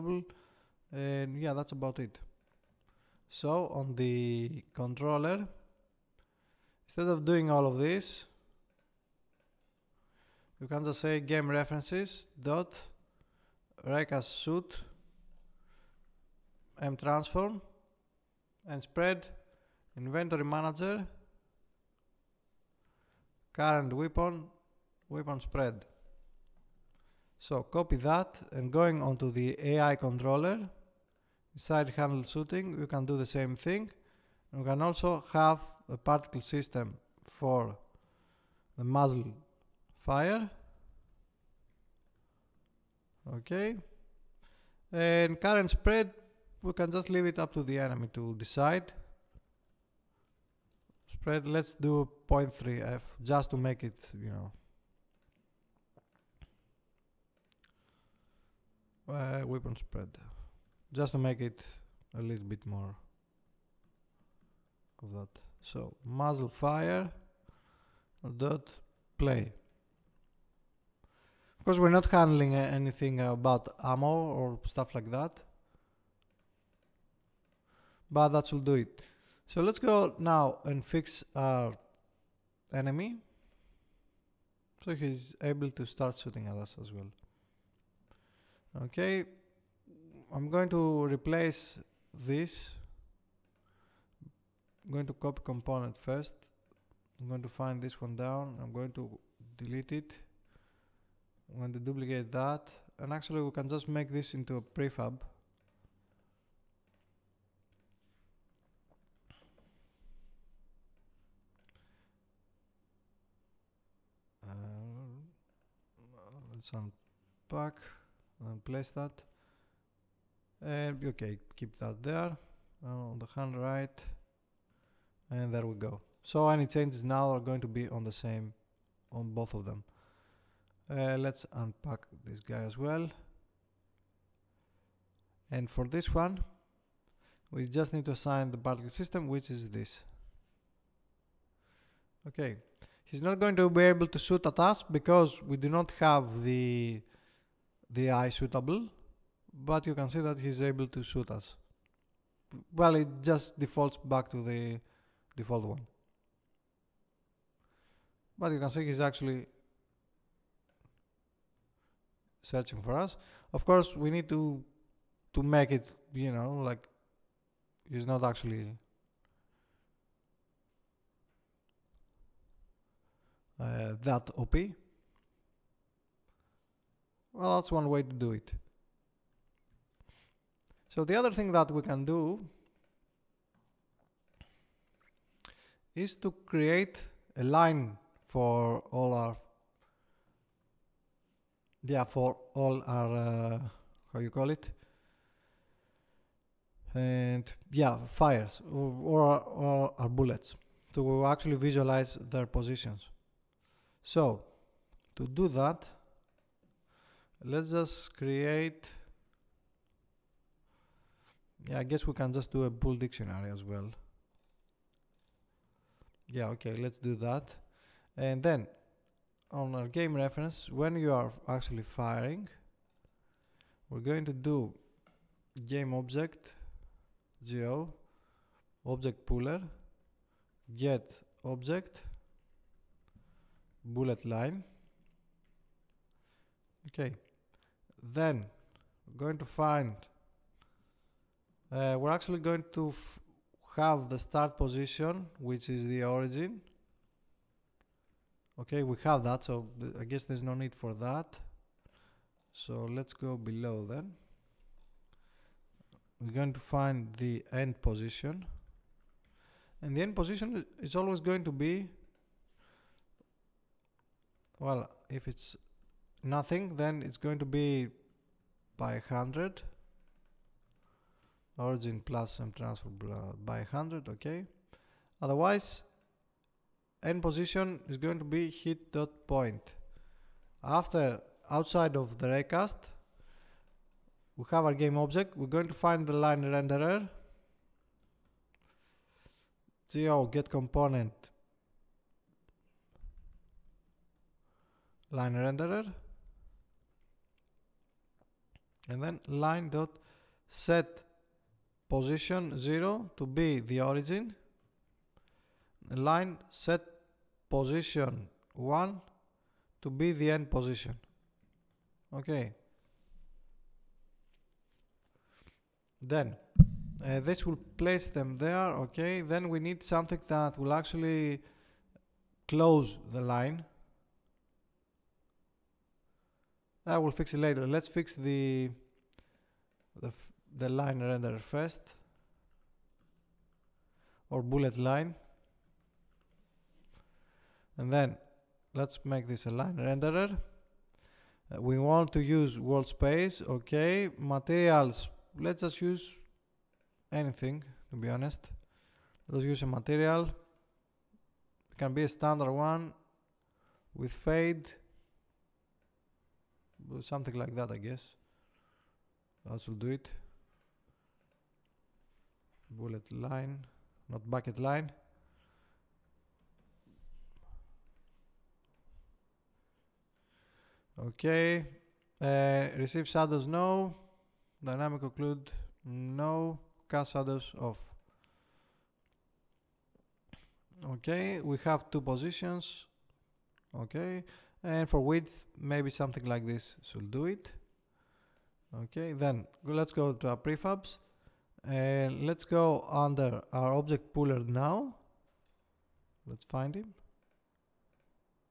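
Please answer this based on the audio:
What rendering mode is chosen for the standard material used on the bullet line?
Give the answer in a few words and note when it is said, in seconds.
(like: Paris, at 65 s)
fade, at 354 s.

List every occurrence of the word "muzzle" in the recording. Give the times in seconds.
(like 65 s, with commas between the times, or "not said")
38 s, 66 s.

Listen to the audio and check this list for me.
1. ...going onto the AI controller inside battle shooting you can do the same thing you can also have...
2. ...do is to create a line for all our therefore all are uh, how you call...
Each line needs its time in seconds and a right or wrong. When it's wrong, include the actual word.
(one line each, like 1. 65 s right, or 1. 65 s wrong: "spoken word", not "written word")
1. 28 s wrong: "handle", not "battle"
2. 182 s right.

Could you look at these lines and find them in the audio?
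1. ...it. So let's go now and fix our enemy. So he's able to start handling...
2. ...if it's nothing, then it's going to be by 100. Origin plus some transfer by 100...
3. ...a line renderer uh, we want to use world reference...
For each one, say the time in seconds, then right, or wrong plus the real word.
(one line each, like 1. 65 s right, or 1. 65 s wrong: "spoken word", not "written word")
1. 78 s wrong: "shooting", not "handling"
2. 265 s right
3. 339 s wrong: "space", not "reference".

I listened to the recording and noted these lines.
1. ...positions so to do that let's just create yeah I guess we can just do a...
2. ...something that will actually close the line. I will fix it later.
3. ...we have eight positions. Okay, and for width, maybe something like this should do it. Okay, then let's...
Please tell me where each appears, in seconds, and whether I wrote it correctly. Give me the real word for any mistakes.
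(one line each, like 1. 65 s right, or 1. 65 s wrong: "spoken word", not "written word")
1. 202 s right
2. 319 s right
3. 381 s wrong: "two", not "eight".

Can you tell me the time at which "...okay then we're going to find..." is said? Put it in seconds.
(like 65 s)
236 s.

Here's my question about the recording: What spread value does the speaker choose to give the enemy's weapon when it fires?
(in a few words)
0.3f.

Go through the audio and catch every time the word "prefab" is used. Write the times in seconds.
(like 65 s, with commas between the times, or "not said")
104 s, 390 s.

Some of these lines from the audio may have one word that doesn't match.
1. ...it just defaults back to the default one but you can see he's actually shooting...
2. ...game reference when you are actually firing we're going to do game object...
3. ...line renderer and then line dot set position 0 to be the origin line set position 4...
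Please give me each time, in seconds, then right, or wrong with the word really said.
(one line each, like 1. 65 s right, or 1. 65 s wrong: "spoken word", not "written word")
1. 152 s wrong: "searching", not "shooting"
2. 219 s right
3. 295 s wrong: "1", not "4".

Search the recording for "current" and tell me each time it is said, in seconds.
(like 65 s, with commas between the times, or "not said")
23 s, 45 s.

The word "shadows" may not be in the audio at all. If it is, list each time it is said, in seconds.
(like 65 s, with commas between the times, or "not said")
373 s, 377 s.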